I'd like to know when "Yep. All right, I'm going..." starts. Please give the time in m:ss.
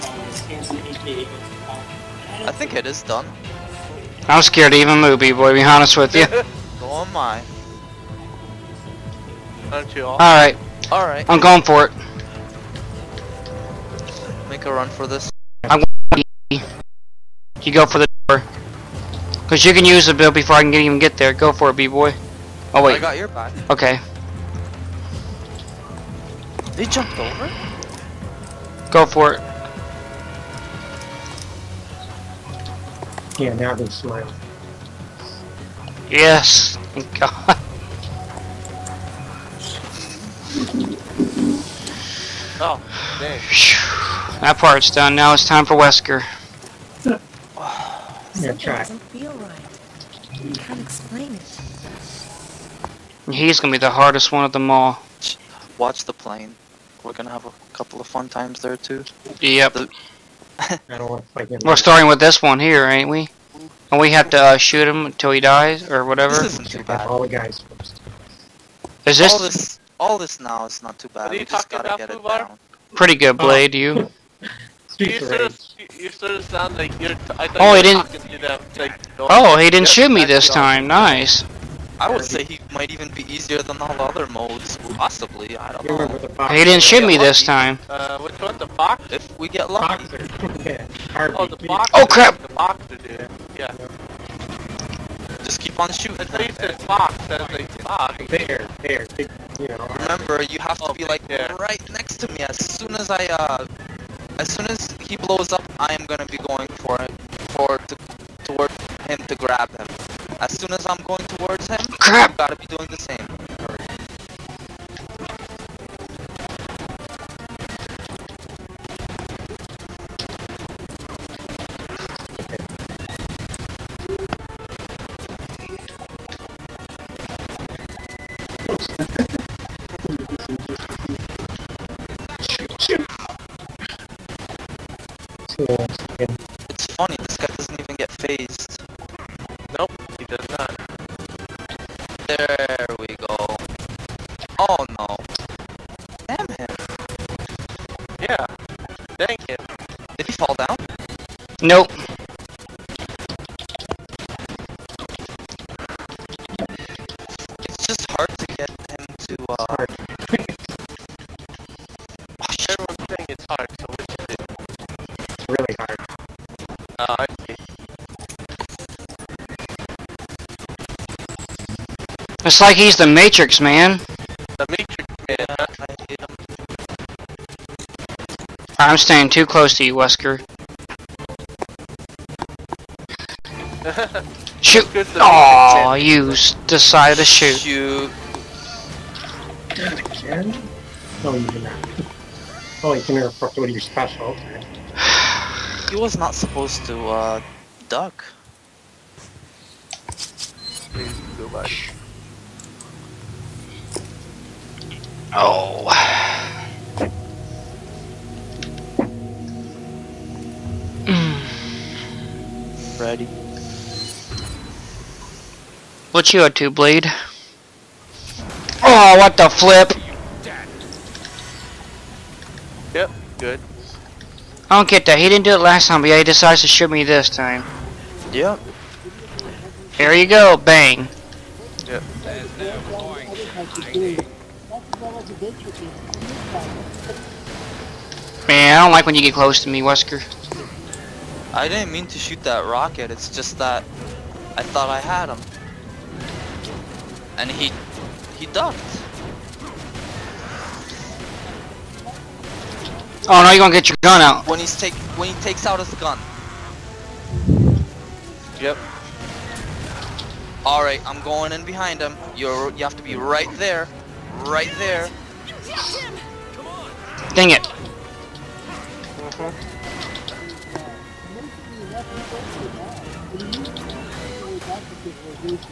4:18.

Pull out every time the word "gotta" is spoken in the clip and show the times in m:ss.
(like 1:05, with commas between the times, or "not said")
1:11, 1:52.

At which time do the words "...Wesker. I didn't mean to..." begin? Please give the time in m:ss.
3:59.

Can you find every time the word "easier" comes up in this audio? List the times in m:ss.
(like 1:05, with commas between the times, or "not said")
1:23.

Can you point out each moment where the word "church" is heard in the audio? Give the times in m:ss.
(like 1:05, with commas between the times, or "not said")
not said.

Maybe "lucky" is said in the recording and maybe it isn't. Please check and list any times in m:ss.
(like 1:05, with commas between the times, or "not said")
1:29.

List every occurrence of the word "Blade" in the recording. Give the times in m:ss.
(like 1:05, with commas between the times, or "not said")
1:13, 3:36.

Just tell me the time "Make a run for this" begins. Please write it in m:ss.
0:14.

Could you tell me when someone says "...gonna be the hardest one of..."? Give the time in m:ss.
0:53.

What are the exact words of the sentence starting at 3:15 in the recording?
he was not supposed to uh, duck.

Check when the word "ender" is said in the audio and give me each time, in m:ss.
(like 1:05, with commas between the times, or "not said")
not said.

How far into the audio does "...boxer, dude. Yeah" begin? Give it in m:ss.
1:32.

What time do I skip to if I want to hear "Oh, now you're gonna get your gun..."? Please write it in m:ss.
4:13.